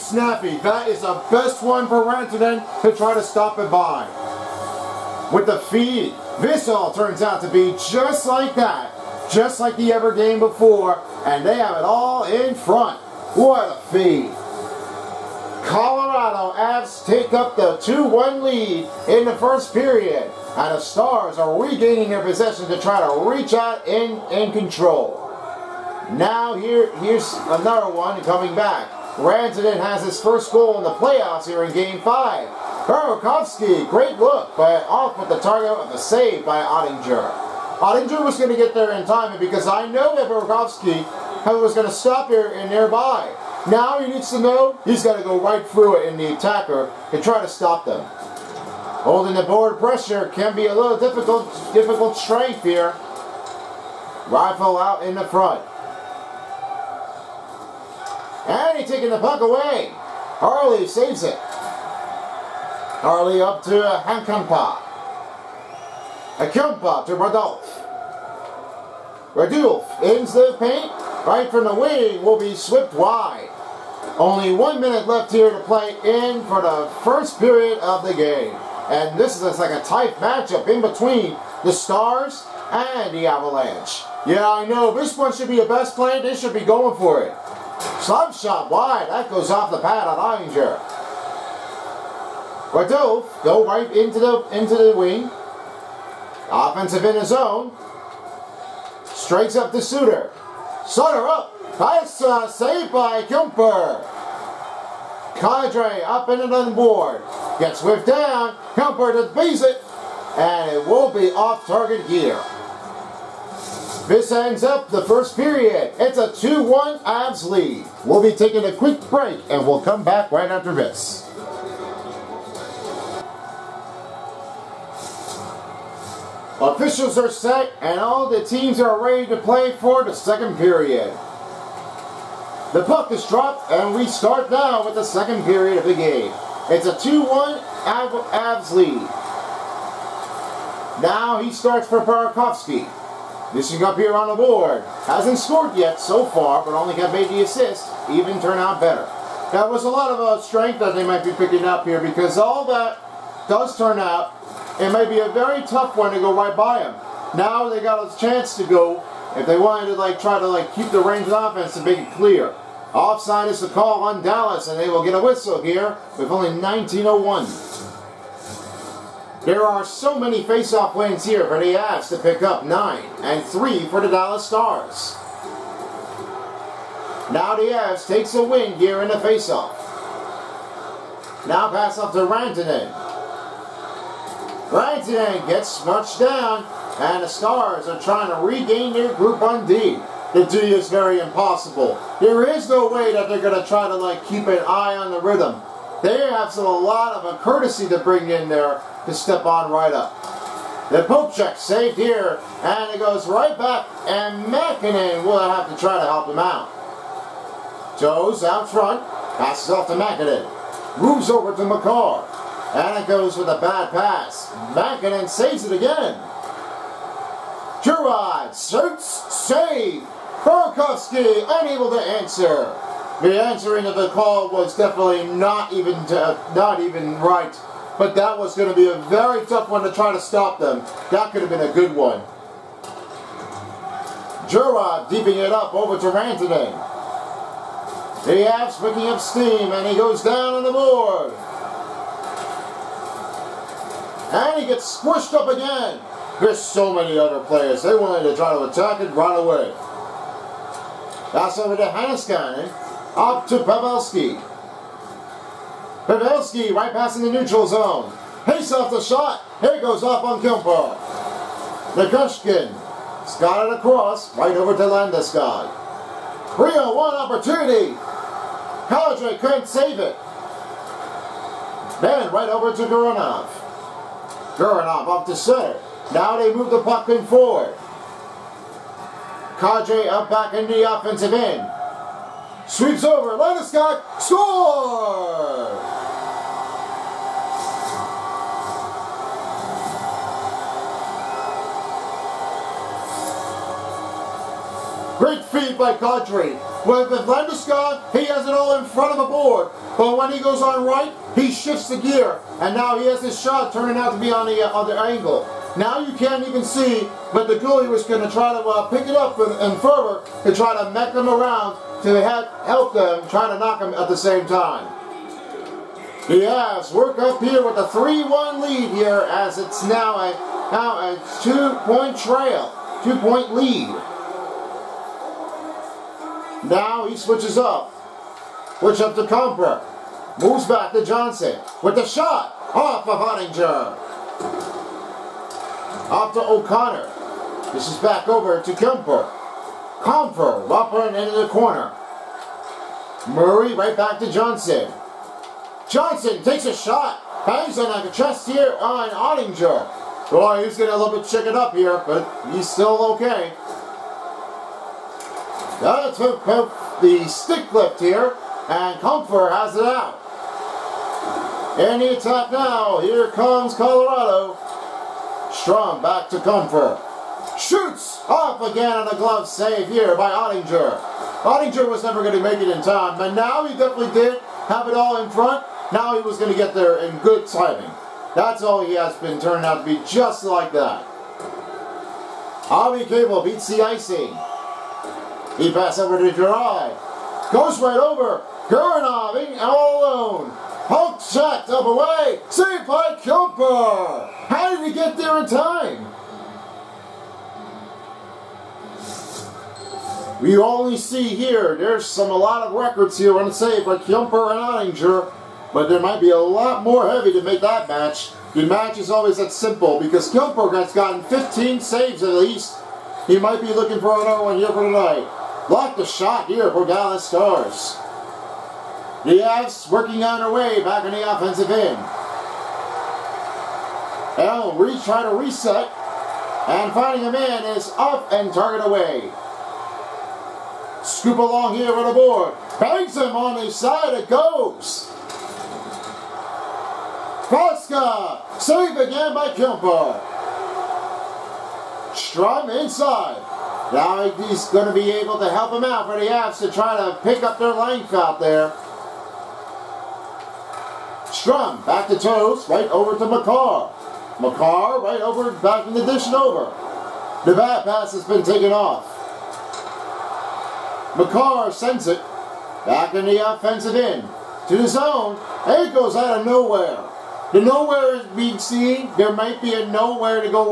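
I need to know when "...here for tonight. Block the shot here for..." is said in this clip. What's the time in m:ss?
6:54.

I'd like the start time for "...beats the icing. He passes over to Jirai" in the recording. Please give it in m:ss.
6:23.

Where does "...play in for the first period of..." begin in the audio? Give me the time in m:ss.
1:15.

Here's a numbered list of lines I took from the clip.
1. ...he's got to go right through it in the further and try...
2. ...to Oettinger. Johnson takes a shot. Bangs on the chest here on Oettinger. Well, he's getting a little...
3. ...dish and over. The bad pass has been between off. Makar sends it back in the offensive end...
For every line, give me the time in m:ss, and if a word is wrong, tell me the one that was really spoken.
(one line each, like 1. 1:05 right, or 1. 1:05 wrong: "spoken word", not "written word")
1. 0:44 wrong: "attacker", not "further"
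2. 5:44 wrong: "Johnson", not "Oettinger"
3. 7:36 wrong: "taken", not "between".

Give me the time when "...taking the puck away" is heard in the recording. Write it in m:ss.
0:58.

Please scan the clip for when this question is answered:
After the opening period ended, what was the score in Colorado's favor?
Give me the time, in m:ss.
1:55.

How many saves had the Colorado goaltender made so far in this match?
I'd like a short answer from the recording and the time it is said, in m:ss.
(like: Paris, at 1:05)
15, at 6:51.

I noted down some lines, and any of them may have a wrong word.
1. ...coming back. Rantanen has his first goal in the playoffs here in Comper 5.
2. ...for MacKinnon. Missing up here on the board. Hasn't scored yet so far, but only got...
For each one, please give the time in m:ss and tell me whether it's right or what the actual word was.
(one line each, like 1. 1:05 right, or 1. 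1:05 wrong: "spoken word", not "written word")
1. 0:28 wrong: "Game", not "Comper"
2. 2:21 wrong: "Burakovsky", not "MacKinnon".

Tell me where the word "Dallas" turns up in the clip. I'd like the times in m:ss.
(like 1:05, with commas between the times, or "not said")
2:44, 2:54, 6:56.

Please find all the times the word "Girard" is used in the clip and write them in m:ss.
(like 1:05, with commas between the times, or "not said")
3:37, 3:54.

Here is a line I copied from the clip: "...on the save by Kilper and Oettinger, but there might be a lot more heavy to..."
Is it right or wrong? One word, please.
right.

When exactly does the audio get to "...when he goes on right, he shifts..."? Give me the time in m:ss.
5:00.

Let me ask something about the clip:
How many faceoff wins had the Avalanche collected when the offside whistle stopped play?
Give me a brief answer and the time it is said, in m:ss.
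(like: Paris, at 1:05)
9, at 2:52.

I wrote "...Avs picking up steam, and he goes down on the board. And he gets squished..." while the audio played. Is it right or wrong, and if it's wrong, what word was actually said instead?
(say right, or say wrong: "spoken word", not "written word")
right.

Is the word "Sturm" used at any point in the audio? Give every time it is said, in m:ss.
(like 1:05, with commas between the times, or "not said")
6:05, 7:22, 7:31.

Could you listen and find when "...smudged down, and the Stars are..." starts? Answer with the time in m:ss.
3:05.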